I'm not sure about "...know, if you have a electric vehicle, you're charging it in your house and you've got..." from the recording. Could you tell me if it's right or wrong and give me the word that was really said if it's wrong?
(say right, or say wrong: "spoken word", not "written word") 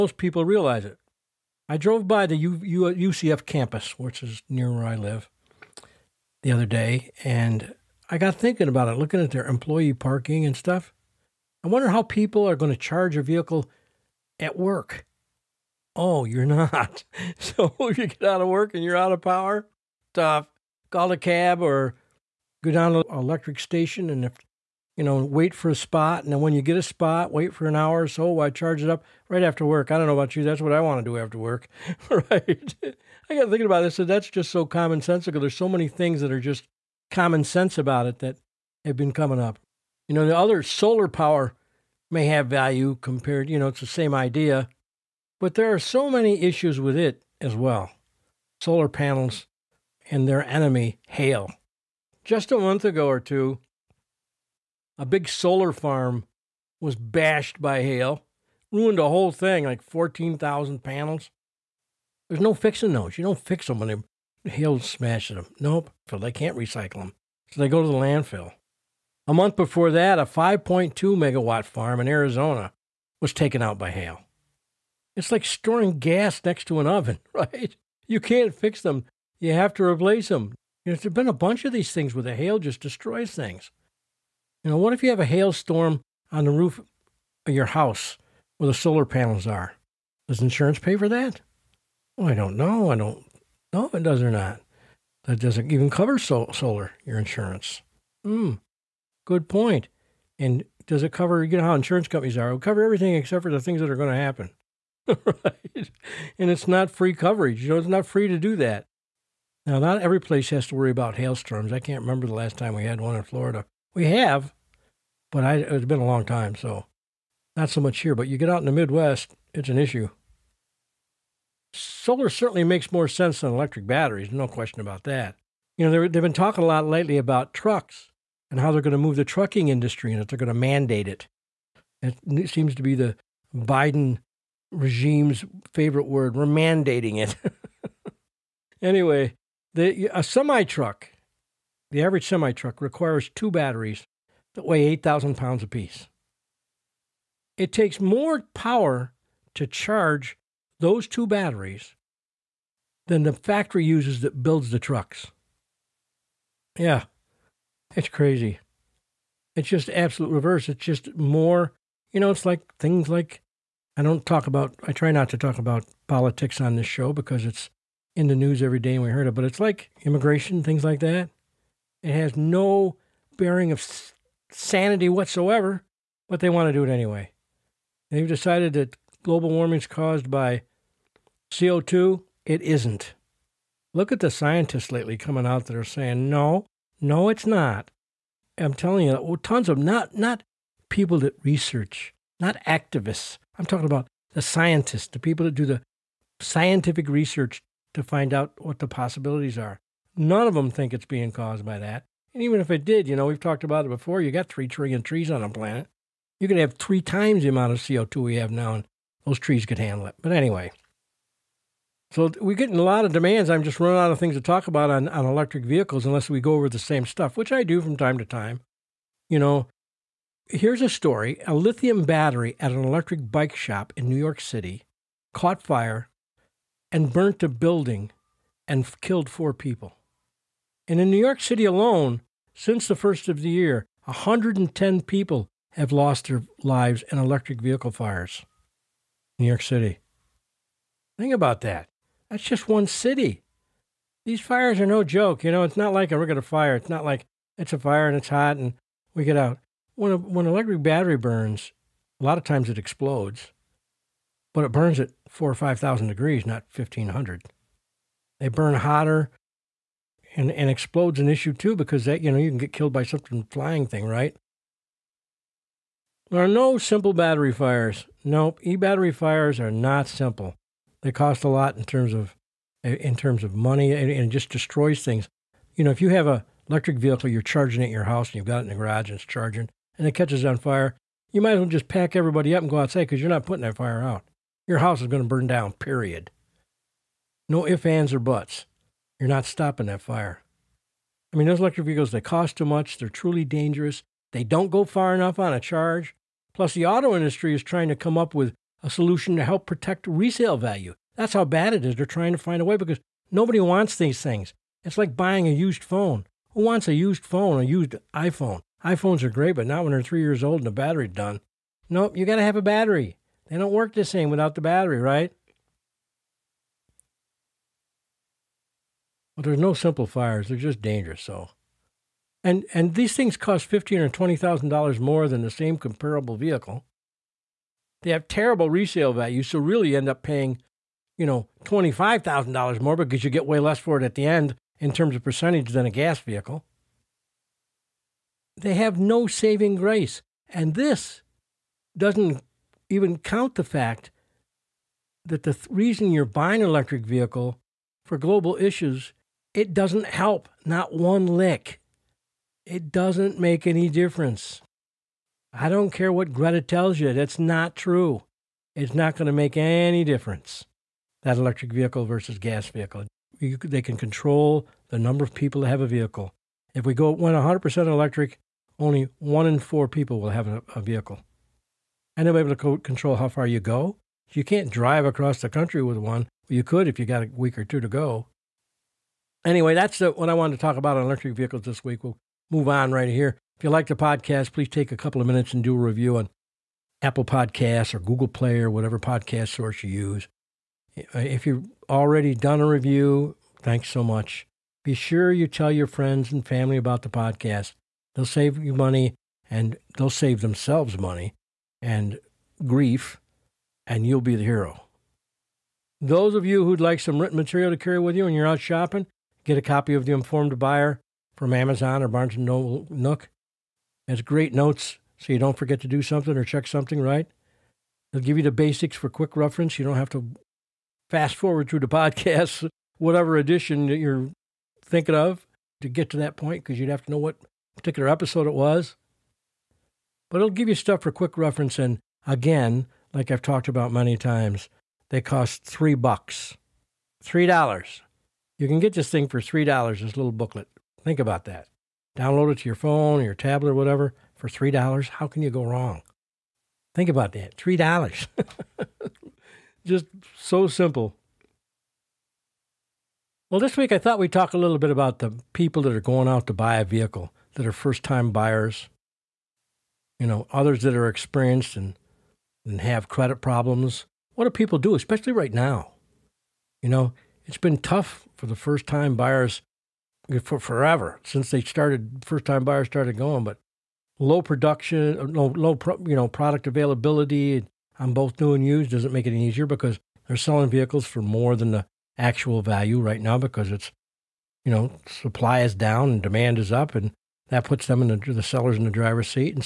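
right.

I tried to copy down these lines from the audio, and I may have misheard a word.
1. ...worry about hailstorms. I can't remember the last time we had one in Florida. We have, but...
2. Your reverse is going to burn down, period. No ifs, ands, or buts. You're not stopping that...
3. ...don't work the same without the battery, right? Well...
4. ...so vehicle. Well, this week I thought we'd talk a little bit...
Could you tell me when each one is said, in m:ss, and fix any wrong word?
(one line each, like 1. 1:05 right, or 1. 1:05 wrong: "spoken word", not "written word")
1. 1:50 right
2. 4:44 wrong: "house", not "reverse"
3. 5:13 right
4. 7:30 wrong: "simple", not "vehicle".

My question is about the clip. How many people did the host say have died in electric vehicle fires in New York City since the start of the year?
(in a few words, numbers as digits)
110.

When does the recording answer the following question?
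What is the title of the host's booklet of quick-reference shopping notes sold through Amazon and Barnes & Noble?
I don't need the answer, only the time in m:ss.
6:50.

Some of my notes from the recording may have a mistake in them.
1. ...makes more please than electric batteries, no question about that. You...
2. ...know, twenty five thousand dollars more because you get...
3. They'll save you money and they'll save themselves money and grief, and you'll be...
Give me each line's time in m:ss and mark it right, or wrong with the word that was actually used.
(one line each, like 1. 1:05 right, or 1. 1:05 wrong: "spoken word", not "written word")
1. 2:02 wrong: "sense", not "please"
2. 5:31 right
3. 6:38 right.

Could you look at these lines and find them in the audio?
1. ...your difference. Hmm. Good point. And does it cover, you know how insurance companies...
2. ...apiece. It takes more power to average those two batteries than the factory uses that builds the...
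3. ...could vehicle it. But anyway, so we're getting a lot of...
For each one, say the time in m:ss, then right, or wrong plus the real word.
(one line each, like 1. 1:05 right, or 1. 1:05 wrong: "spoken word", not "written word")
1. 1:37 wrong: "insurance", not "difference"
2. 2:25 wrong: "charge", not "average"
3. 3:29 wrong: "handle", not "vehicle".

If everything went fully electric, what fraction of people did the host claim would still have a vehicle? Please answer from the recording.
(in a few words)
One in four.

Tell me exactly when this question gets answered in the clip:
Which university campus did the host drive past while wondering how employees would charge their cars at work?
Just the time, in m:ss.
0:03.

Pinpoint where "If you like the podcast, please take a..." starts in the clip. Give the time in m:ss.
6:23.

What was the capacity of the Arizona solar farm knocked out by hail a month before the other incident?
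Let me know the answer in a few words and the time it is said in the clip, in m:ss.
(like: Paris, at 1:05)
5.2 megawatts, at 1:10.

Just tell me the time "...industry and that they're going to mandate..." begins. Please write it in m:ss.
2:09.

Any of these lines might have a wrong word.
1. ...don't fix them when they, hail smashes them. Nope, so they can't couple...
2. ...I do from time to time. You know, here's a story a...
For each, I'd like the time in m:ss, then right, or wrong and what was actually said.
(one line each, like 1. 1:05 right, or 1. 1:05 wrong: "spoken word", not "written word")
1. 1:03 wrong: "recycle", not "couple"
2. 3:37 right.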